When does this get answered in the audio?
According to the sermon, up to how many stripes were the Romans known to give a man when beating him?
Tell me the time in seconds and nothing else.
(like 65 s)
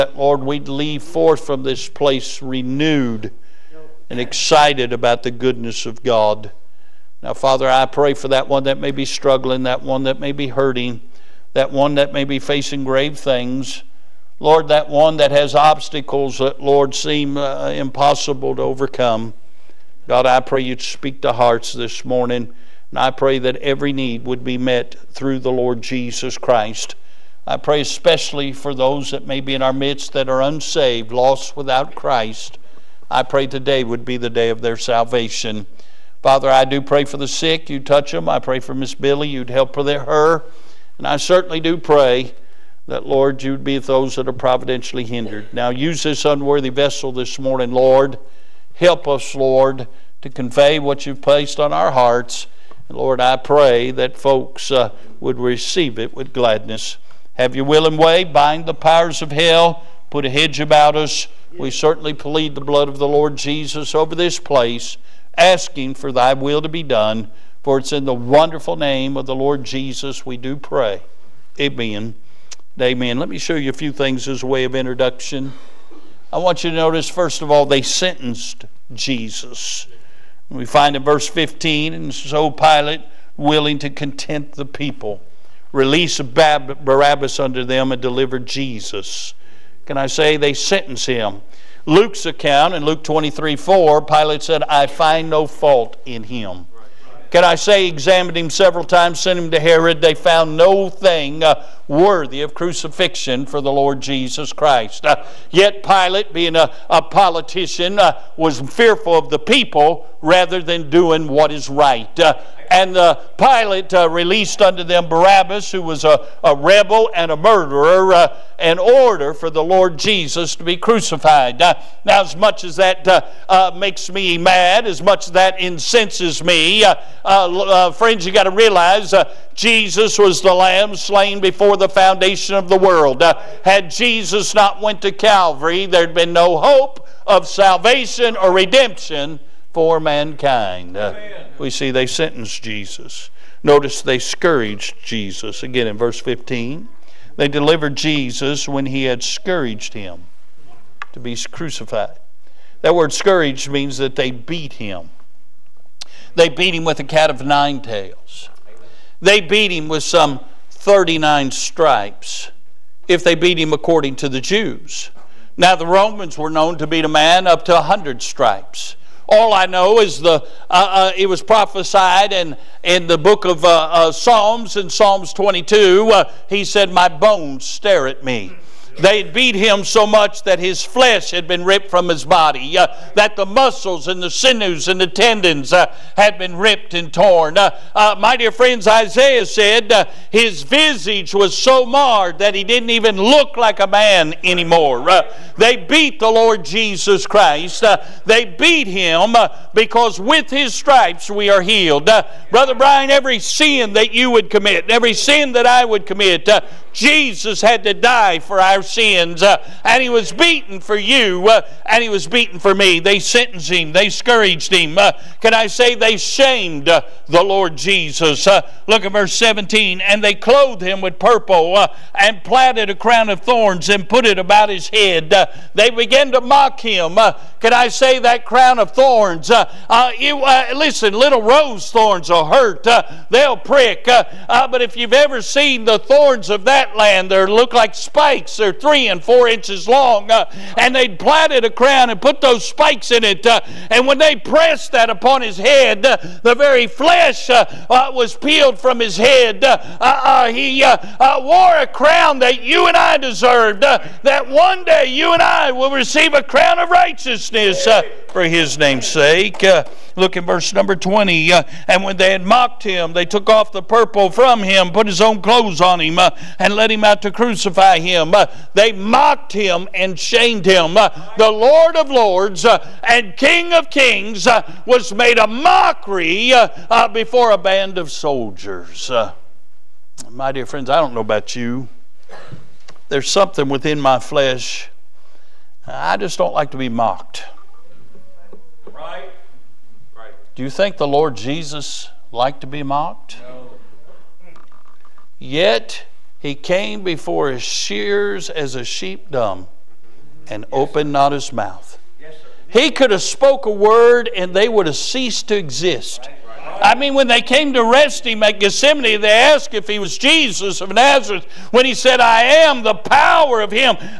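167 s.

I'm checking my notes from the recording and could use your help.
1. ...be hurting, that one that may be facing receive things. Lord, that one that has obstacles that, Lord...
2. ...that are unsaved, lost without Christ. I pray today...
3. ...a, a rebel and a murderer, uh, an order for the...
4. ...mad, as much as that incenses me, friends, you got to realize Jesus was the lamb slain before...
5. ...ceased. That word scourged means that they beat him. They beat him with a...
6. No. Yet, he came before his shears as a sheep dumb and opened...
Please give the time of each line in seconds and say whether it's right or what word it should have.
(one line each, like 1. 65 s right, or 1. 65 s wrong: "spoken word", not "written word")
1. 10 s wrong: "grave", not "receive"
2. 30 s right
3. 116 s right
4. 124 s right
5. 151 s wrong: "crucified", not "ceased"
6. 293 s right.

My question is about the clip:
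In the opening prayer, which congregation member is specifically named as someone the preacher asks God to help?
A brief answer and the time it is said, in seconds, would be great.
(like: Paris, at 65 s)
Miss Billy, at 38 s.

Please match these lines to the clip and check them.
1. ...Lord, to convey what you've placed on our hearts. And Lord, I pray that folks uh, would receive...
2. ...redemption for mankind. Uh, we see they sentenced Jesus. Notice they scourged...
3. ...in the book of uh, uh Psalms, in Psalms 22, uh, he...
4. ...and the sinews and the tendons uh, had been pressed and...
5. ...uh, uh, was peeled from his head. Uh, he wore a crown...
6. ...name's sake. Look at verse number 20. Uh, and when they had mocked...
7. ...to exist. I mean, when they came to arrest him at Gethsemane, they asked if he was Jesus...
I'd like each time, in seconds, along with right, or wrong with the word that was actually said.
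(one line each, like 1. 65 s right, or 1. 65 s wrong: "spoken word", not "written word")
1. 49 s right
2. 138 s right
3. 172 s right
4. 184 s wrong: "ripped", not "pressed"
5. 247 s right
6. 258 s right
7. 305 s right.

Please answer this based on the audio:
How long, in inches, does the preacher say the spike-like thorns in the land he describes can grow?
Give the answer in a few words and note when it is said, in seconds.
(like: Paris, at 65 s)
3 and 4 inches, at 238 s.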